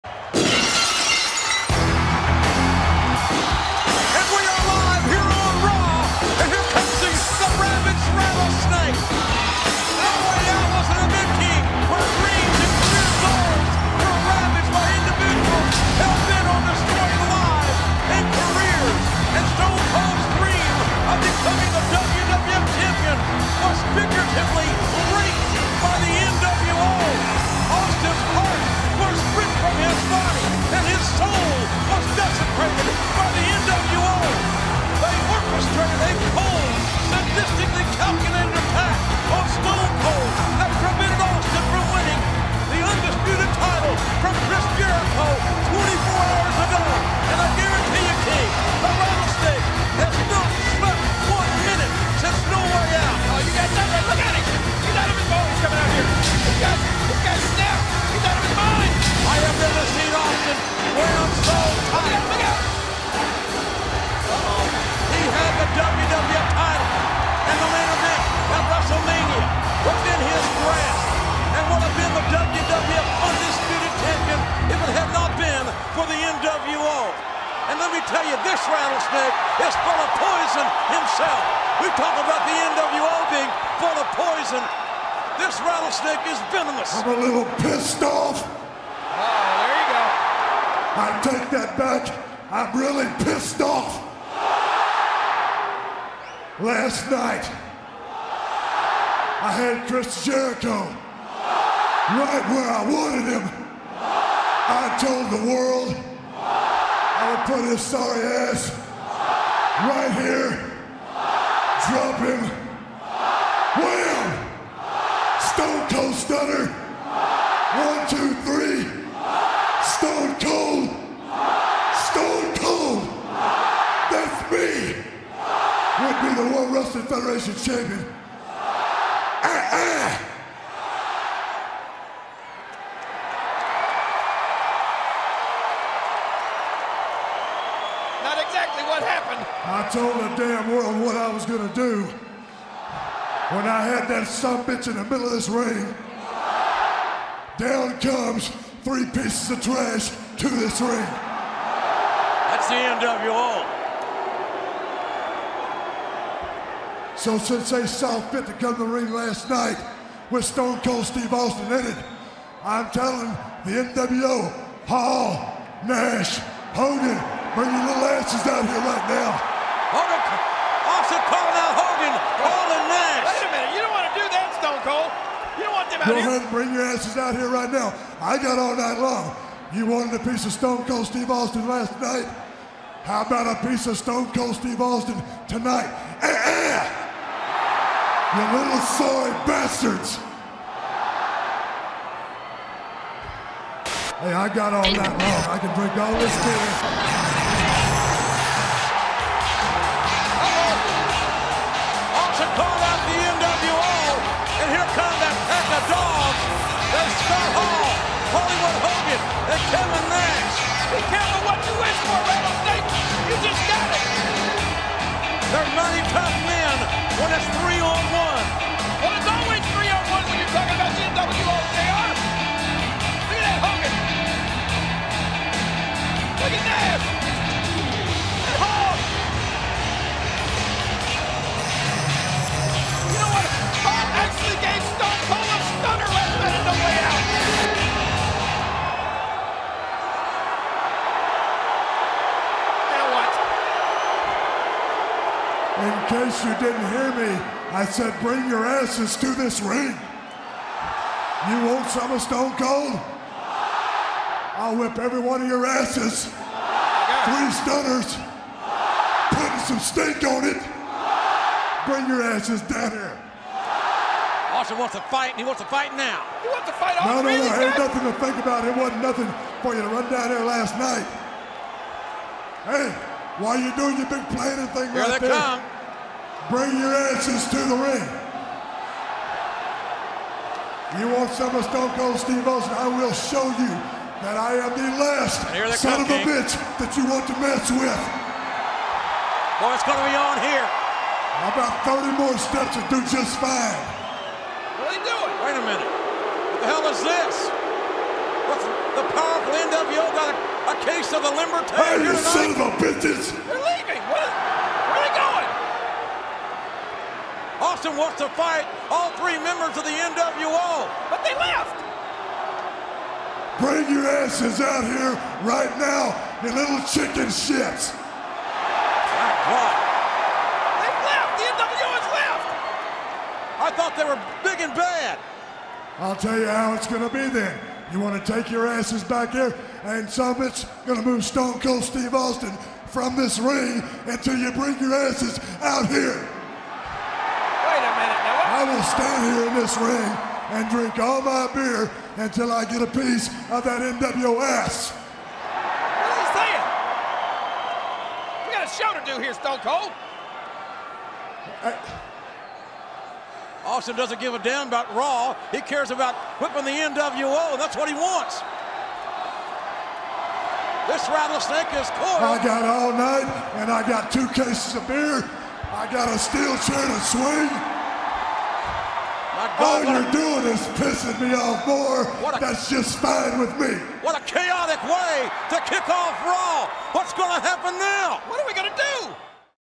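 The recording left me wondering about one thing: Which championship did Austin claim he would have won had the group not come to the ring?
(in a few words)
World Wrestling Federation champion.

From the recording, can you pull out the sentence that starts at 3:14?
Hey, I got all night long.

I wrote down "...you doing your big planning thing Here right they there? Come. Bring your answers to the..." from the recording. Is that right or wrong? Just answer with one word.
right.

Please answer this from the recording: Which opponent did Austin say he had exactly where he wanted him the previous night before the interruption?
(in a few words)
Chris Jericho.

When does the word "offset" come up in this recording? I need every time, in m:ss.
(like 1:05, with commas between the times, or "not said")
2:50.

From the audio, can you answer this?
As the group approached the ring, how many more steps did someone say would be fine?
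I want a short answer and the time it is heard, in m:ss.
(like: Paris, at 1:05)
30, at 4:51.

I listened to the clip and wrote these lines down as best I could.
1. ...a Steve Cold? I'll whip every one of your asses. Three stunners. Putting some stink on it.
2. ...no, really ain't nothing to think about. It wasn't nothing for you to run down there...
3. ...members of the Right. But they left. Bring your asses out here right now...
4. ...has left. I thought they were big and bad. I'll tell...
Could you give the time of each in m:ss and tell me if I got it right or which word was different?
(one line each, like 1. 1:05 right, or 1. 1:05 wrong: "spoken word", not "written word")
1. 4:12 wrong: "Stone", not "Steve"
2. 4:27 right
3. 5:09 wrong: "NWO", not "Right"
4. 5:21 right.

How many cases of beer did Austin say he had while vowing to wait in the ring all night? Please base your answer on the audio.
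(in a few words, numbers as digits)
2.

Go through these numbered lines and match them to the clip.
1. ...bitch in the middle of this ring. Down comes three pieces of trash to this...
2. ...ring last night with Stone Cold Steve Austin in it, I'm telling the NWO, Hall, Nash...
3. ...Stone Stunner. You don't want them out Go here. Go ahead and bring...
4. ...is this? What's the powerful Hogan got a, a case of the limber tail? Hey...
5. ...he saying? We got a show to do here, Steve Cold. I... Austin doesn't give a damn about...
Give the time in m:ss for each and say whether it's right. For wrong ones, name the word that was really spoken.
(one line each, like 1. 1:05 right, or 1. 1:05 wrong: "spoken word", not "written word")
1. 2:24 right
2. 2:38 right
3. 2:54 wrong: "Cold", not "Stunner"
4. 4:56 wrong: "NWO", not "Hogan"
5. 5:46 wrong: "Stone", not "Steve".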